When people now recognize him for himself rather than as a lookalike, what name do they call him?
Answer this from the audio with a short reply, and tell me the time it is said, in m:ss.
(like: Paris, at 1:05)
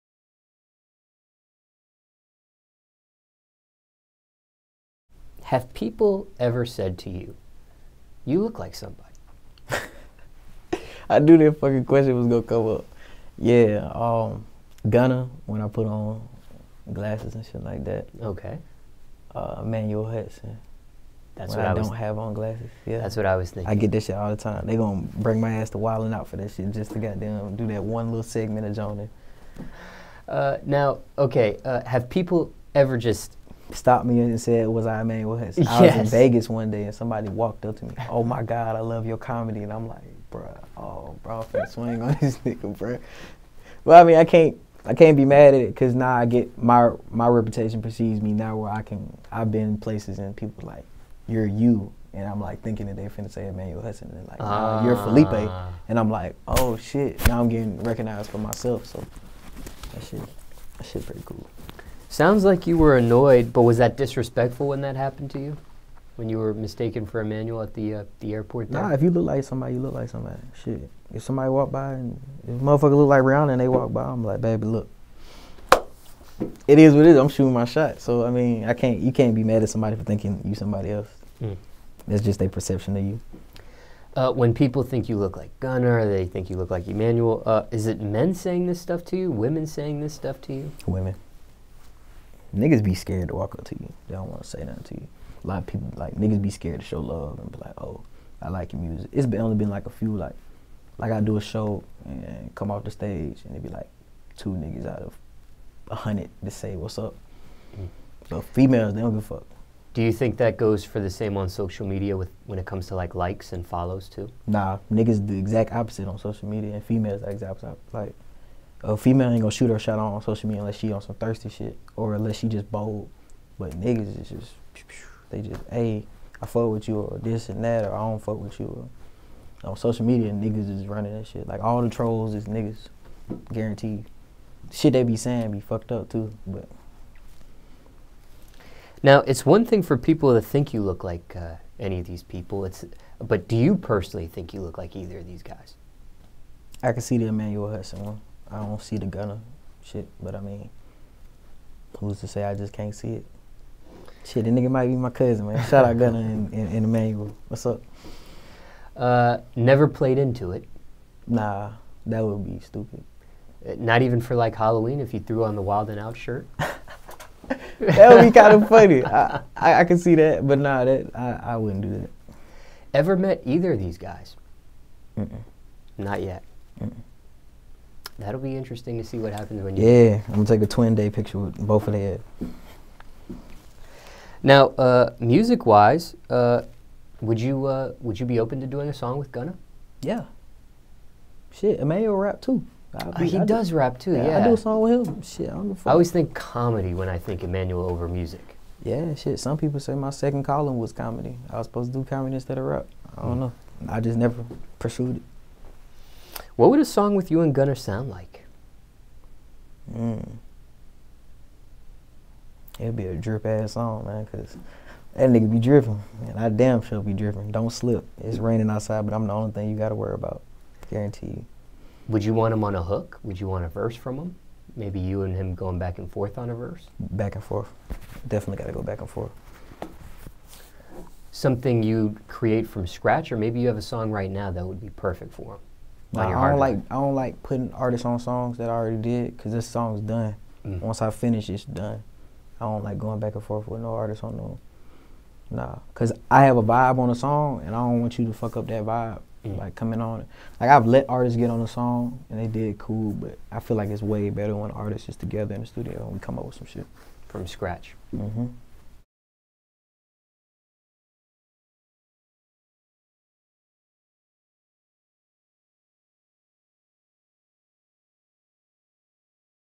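Felipe, at 0:55.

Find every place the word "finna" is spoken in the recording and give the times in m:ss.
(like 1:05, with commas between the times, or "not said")
0:53.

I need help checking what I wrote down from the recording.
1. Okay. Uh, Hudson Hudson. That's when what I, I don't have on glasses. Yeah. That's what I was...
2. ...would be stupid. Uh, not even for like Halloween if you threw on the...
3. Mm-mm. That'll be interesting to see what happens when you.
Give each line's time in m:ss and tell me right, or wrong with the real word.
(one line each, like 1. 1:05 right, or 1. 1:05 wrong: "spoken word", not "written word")
1. 0:18 wrong: "Emmanuel", not "Hudson"
2. 2:42 right
3. 2:56 right.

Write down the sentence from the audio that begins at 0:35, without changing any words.
I was in Vegas one day and somebody walked up to me.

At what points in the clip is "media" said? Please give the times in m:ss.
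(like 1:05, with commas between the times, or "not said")
1:51, 1:56, 2:00, 2:10.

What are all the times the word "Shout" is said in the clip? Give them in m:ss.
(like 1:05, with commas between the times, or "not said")
2:35.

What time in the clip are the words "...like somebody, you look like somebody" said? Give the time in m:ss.
1:09.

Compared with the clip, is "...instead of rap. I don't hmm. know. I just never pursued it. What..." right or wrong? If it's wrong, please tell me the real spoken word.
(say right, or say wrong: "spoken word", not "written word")
right.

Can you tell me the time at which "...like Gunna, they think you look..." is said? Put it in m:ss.
1:25.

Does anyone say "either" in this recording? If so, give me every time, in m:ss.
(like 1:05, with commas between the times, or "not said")
2:24, 2:53.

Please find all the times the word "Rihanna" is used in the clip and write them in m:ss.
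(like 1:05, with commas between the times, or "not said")
1:13.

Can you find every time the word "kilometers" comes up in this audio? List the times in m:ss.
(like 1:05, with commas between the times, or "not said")
not said.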